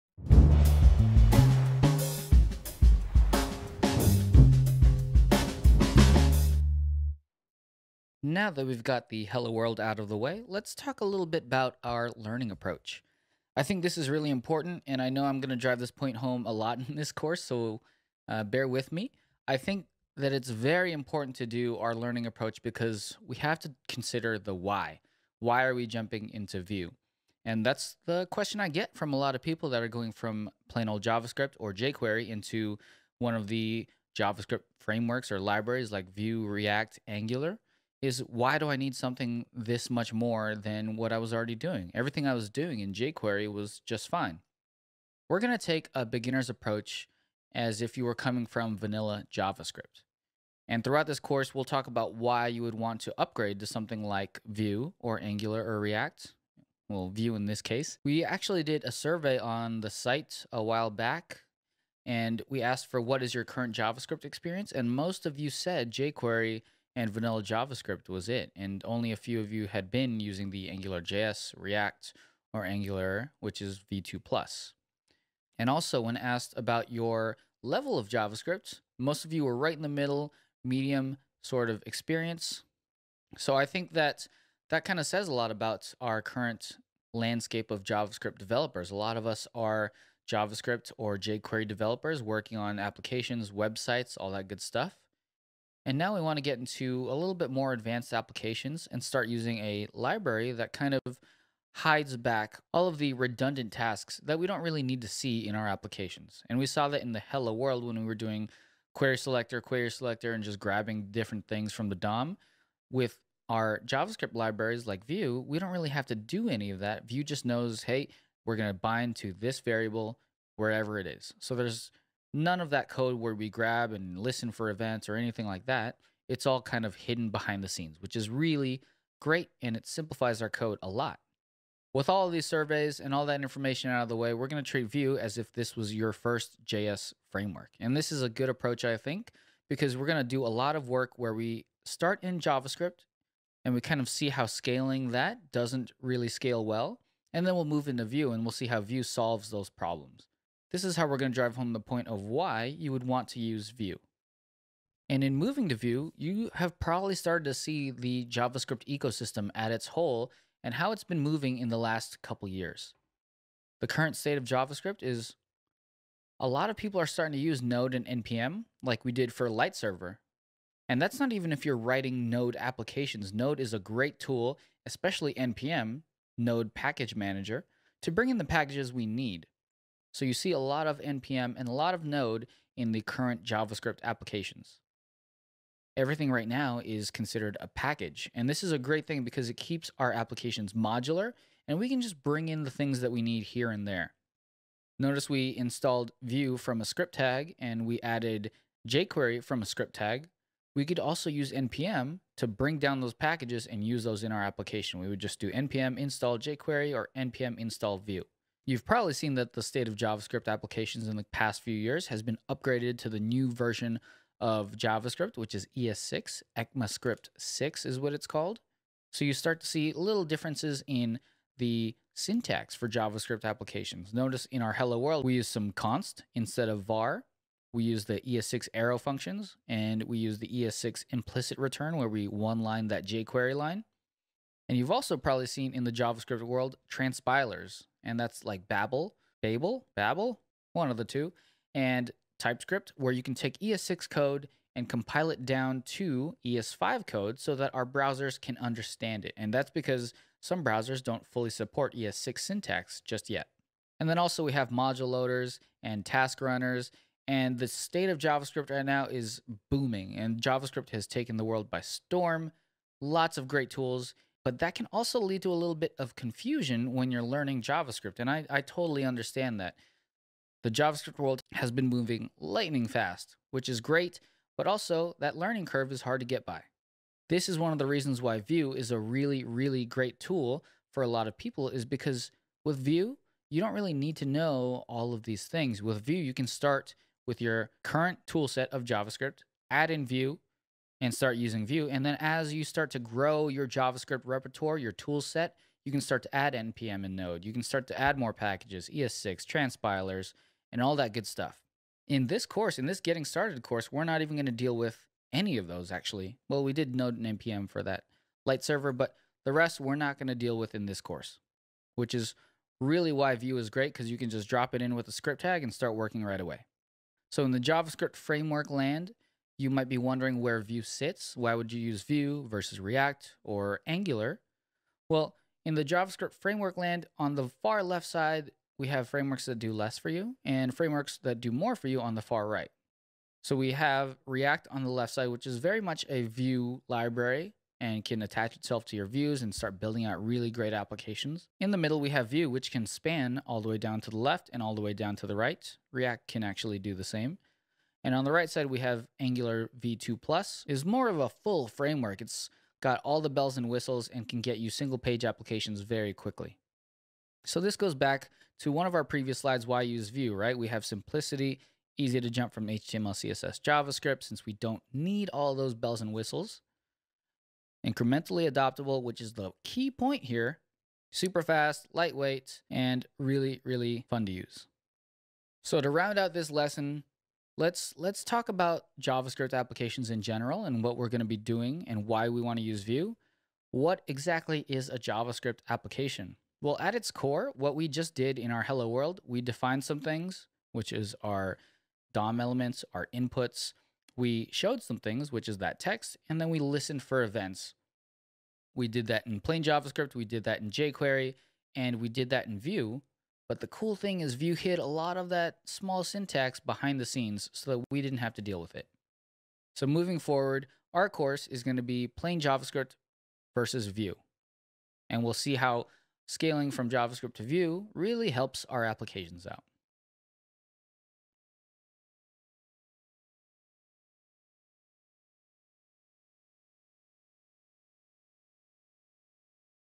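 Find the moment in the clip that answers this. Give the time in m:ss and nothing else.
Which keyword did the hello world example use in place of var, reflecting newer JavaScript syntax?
3:45.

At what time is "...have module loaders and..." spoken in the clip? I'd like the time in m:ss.
4:14.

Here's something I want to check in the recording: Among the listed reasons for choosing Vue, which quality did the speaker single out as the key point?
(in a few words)
Incrementally adoptable.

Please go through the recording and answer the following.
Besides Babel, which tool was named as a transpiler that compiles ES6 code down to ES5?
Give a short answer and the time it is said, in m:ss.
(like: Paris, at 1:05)
TypeScript, at 4:02.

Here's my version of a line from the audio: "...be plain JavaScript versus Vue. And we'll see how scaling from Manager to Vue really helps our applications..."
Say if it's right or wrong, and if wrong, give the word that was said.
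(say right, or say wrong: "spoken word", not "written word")
wrong: "JavaScript", not "Manager".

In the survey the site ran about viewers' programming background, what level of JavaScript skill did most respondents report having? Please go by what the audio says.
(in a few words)
medium.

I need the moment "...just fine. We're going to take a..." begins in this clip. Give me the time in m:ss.
0:43.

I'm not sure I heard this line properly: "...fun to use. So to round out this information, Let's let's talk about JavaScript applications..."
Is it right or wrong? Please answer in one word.
wrong.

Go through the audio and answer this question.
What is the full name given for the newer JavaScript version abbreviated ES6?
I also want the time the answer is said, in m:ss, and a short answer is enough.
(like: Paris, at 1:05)
ECMAScript 6, at 3:36.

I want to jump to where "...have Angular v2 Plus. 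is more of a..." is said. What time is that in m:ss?
5:48.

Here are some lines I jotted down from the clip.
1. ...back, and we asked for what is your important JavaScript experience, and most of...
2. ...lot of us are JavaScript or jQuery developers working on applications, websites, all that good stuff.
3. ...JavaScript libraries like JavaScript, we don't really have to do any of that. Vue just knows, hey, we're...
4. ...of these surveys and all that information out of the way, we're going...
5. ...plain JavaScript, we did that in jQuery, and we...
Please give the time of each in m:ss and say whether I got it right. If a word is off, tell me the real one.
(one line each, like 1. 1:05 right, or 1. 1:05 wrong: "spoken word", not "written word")
1. 1:00 wrong: "current", not "important"
2. 1:28 right
3. 1:53 wrong: "Vue", not "JavaScript"
4. 2:12 right
5. 6:39 right.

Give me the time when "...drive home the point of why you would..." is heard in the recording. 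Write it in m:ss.
2:31.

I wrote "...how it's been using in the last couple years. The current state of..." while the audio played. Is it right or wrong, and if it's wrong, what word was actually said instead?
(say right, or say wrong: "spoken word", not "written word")
wrong: "moving", not "using".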